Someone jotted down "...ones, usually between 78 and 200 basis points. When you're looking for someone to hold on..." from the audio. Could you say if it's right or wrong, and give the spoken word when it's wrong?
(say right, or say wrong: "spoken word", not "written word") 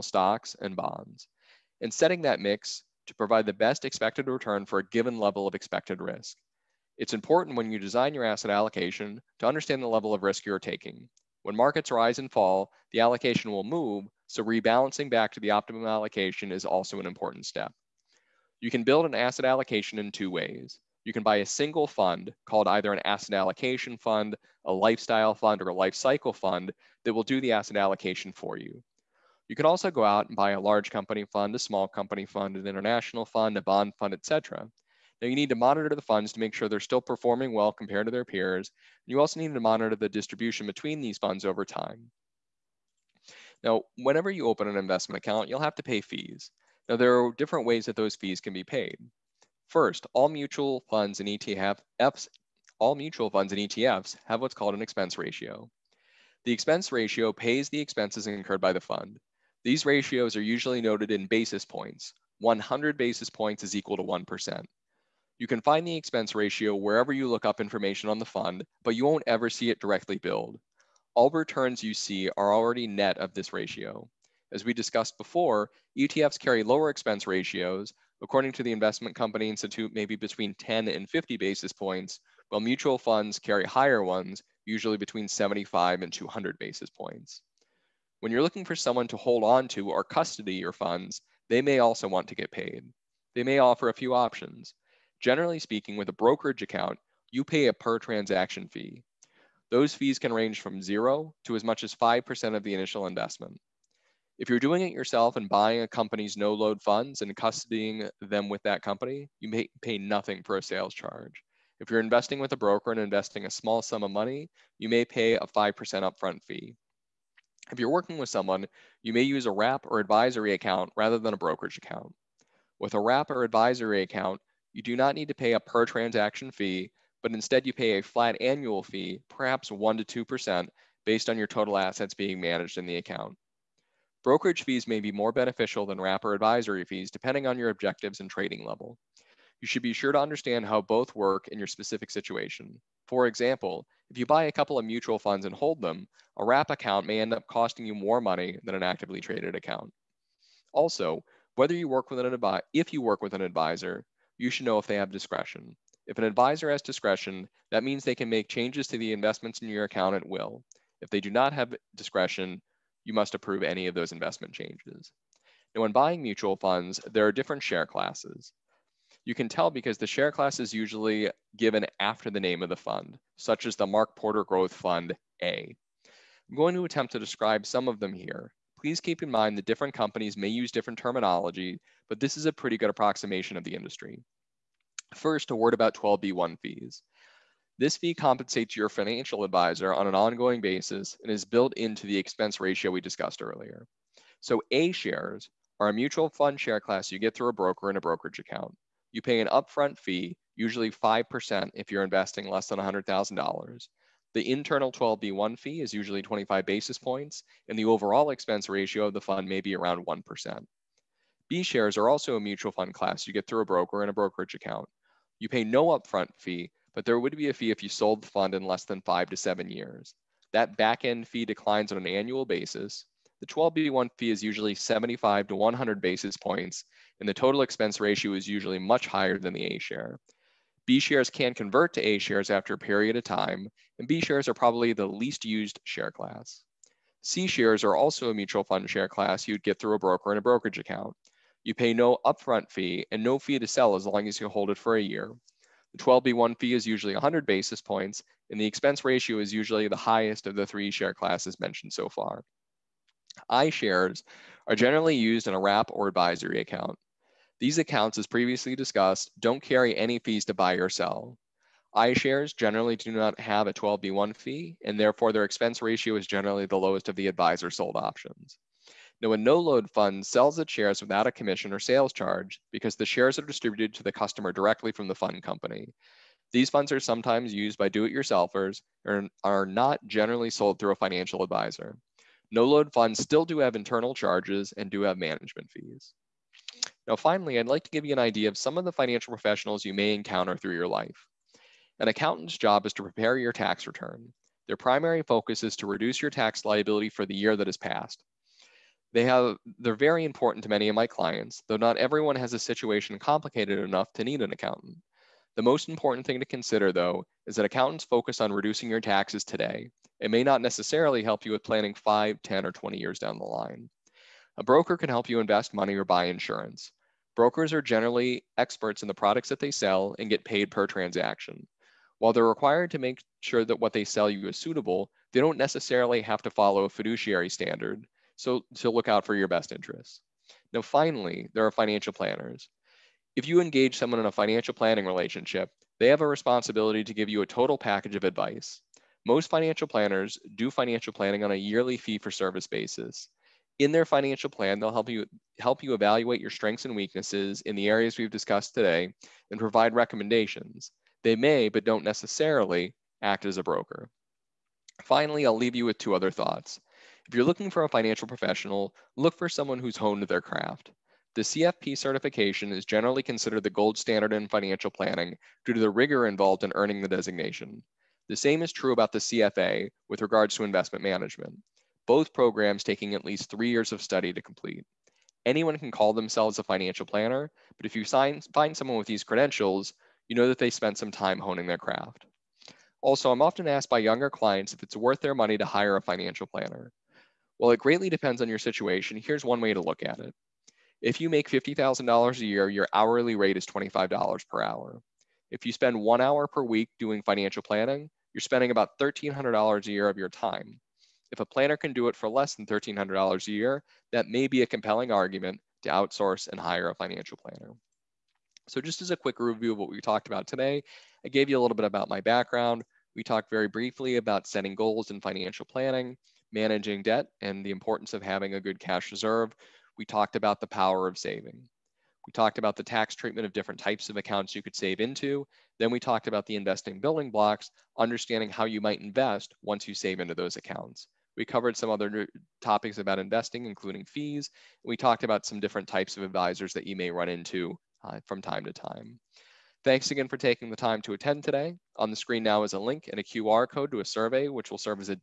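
wrong: "75", not "78".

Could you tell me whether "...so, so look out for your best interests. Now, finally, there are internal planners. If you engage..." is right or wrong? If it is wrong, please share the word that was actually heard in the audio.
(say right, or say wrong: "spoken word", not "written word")
wrong: "financial", not "internal".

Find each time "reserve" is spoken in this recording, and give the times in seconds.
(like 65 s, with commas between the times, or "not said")
419 s.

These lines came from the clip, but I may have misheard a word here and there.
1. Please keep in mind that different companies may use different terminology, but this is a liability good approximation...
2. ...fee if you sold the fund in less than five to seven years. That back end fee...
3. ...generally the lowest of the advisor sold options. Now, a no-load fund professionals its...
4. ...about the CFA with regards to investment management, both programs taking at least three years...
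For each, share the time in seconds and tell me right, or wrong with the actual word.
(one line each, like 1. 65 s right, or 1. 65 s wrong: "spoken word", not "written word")
1. 178 s wrong: "pretty", not "liability"
2. 217 s right
3. 266 s wrong: "sells", not "professionals"
4. 368 s right.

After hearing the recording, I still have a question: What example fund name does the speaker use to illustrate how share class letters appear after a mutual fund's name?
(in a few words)
Mark Porter Growth Fund A.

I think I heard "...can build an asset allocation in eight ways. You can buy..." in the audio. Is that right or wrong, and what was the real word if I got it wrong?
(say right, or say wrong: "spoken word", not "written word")
wrong: "two", not "eight".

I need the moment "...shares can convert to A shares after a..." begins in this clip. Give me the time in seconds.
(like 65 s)
230 s.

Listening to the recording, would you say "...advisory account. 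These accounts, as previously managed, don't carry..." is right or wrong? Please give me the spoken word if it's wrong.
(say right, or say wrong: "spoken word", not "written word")
wrong: "discussed", not "managed".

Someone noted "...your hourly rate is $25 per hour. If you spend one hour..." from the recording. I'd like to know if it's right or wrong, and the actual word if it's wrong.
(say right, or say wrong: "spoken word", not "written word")
right.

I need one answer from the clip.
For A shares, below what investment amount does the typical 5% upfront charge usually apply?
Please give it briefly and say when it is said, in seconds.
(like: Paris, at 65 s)
$100,000, at 202 s.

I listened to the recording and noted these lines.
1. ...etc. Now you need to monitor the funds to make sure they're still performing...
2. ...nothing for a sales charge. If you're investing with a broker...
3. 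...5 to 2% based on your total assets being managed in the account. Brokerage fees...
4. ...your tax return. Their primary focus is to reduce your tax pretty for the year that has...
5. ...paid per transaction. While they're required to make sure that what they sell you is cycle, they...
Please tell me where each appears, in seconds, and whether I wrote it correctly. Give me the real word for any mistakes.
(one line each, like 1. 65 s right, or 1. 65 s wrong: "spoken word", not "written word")
1. 34 s right
2. 109 s right
3. 129 s wrong: "1", not "5"
4. 293 s wrong: "liability", not "pretty"
5. 320 s wrong: "suitable", not "cycle".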